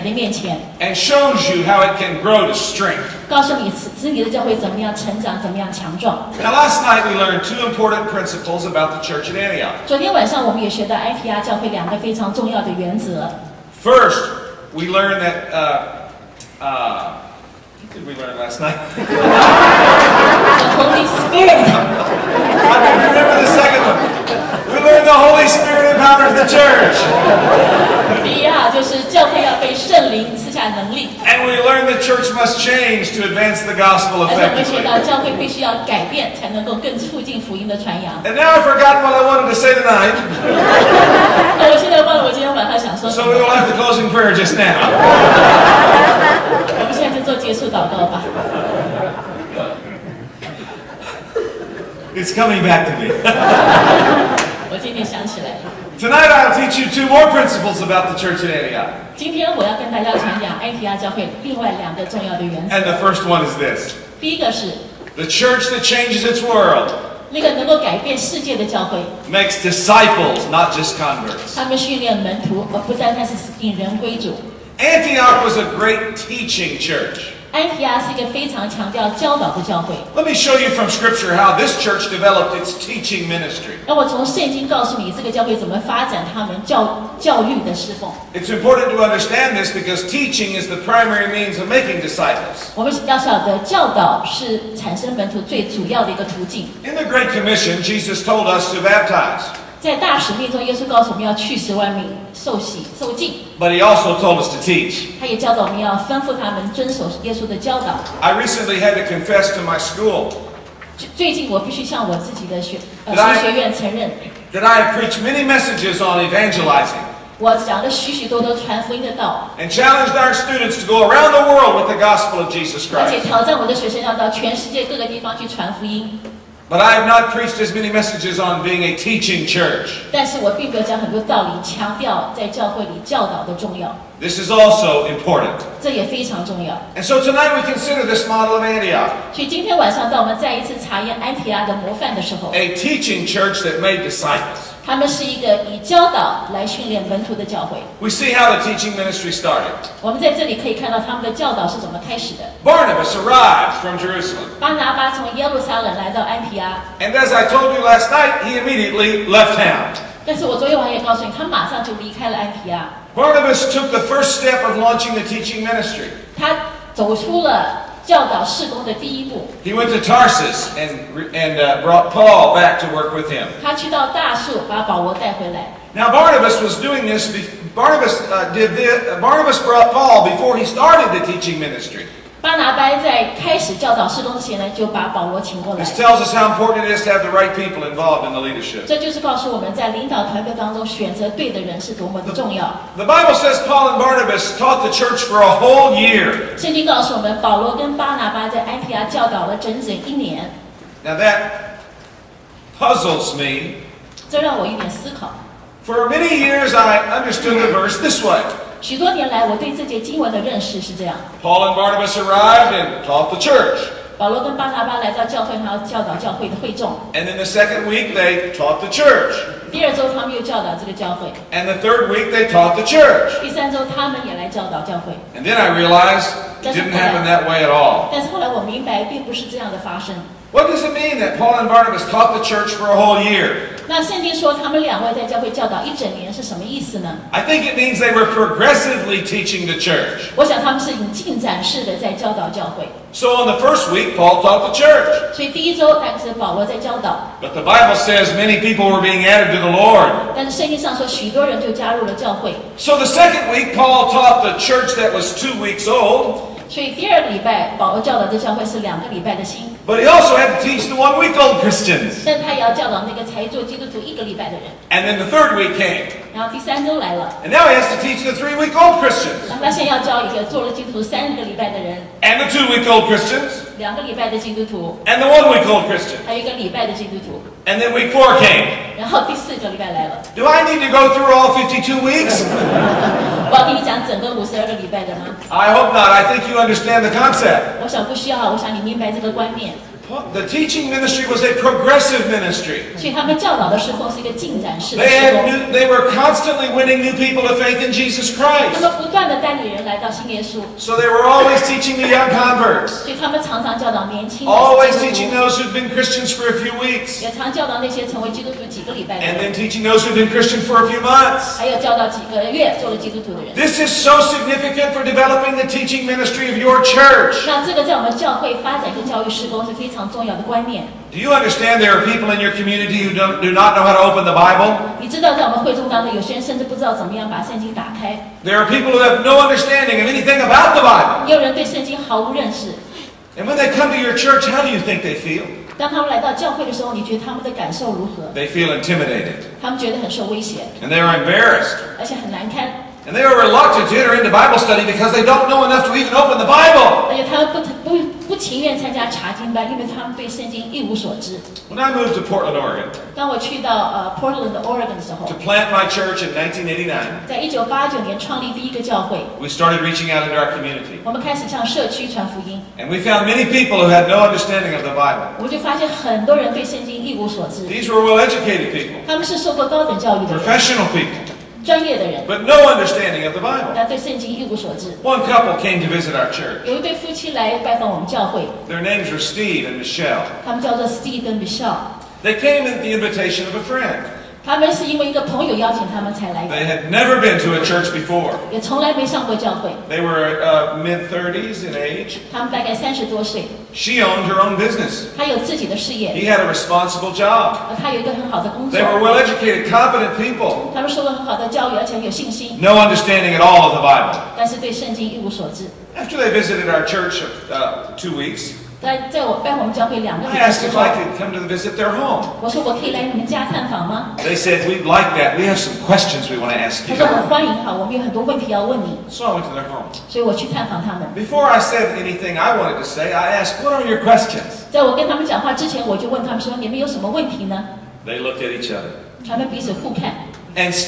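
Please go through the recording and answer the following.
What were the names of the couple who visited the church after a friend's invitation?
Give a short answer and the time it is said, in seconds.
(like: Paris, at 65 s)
Steve and Michelle, at 379 s.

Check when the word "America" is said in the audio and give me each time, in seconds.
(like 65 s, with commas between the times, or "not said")
not said.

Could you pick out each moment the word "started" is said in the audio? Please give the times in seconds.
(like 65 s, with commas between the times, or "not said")
149 s, 180 s, 359 s.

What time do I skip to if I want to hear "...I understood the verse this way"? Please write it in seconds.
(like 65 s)
206 s.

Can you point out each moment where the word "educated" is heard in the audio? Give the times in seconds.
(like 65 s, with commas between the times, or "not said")
368 s, 399 s.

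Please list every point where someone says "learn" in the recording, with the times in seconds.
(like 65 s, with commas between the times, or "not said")
24 s, 31 s.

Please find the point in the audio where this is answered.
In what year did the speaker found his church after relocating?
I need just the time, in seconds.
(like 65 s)
356 s.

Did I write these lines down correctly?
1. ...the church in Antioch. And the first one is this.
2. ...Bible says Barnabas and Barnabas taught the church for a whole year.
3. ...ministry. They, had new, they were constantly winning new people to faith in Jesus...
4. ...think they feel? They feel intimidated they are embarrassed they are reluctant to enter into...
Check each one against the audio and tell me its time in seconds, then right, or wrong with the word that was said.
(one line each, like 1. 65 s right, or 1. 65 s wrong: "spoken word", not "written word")
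1. 58 s right
2. 193 s wrong: "Paul", not "Barnabas"
3. 292 s right
4. 334 s right.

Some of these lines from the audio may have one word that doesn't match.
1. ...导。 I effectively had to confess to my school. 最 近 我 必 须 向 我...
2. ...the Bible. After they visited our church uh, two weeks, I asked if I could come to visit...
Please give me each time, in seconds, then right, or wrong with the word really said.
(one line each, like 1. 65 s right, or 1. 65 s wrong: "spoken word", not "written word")
1. 107 s wrong: "recently", not "effectively"
2. 403 s right.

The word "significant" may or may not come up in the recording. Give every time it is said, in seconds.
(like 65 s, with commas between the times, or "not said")
314 s.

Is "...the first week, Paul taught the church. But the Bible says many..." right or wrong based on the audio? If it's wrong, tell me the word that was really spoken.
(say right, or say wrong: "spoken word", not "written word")
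right.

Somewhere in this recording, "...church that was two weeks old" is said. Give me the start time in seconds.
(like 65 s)
254 s.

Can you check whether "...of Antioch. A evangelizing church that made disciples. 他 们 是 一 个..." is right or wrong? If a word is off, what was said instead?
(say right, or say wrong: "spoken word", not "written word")
wrong: "teaching", not "evangelizing".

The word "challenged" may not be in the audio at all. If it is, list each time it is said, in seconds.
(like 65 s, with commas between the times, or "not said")
119 s.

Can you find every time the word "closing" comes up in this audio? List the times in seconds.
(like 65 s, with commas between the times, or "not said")
43 s.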